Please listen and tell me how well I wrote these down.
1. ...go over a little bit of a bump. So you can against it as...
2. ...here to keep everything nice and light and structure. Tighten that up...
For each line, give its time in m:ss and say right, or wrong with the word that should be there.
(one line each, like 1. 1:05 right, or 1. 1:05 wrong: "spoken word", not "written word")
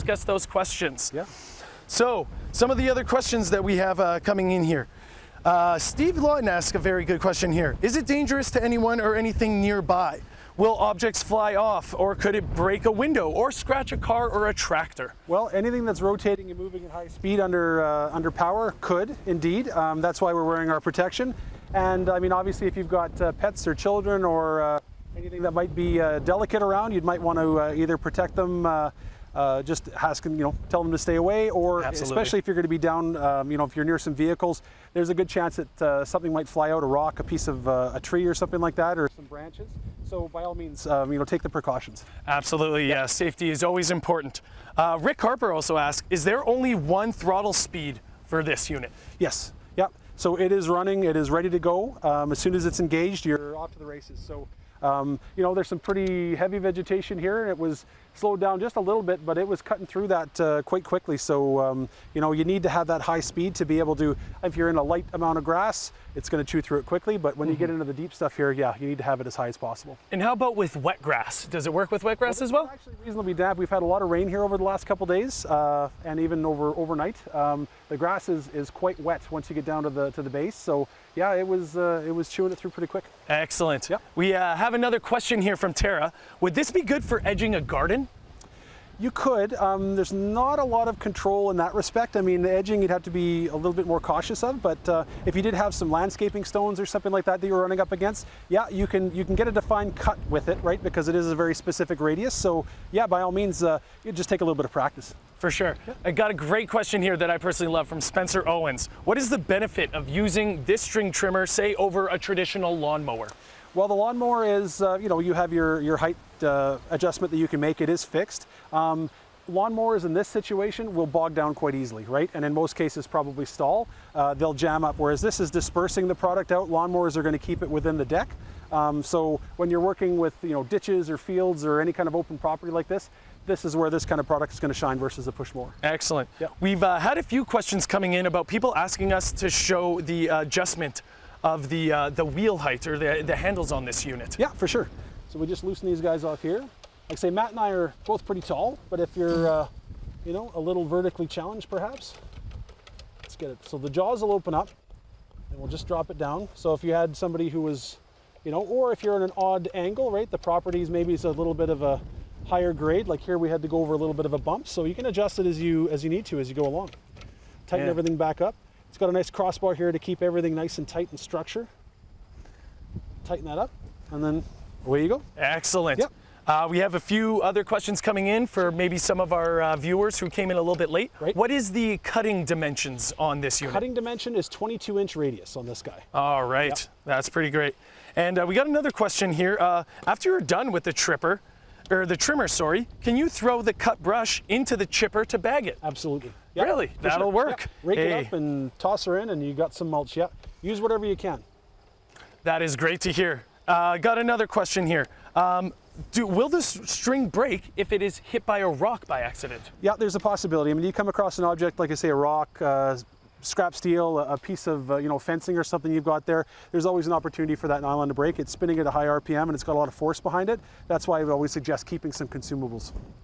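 1. 2:43 wrong: "adjust", not "against"
2. 2:49 wrong: "tight", not "light".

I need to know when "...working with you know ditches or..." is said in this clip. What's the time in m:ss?
2:09.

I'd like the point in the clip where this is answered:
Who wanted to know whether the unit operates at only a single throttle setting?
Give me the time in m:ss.
0:44.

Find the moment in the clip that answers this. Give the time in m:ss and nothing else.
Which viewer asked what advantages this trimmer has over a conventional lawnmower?
1:48.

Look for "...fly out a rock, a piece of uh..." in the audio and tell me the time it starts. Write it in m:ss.
0:36.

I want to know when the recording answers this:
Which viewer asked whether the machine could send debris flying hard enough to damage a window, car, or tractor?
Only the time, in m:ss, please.
0:05.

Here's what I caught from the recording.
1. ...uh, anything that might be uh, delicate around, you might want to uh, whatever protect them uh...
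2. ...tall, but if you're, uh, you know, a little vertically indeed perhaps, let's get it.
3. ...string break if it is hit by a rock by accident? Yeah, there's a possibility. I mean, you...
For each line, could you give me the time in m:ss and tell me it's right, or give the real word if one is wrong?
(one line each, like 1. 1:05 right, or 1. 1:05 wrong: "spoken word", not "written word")
1. 0:24 wrong: "either", not "whatever"
2. 2:28 wrong: "challenged", not "indeed"
3. 3:26 right.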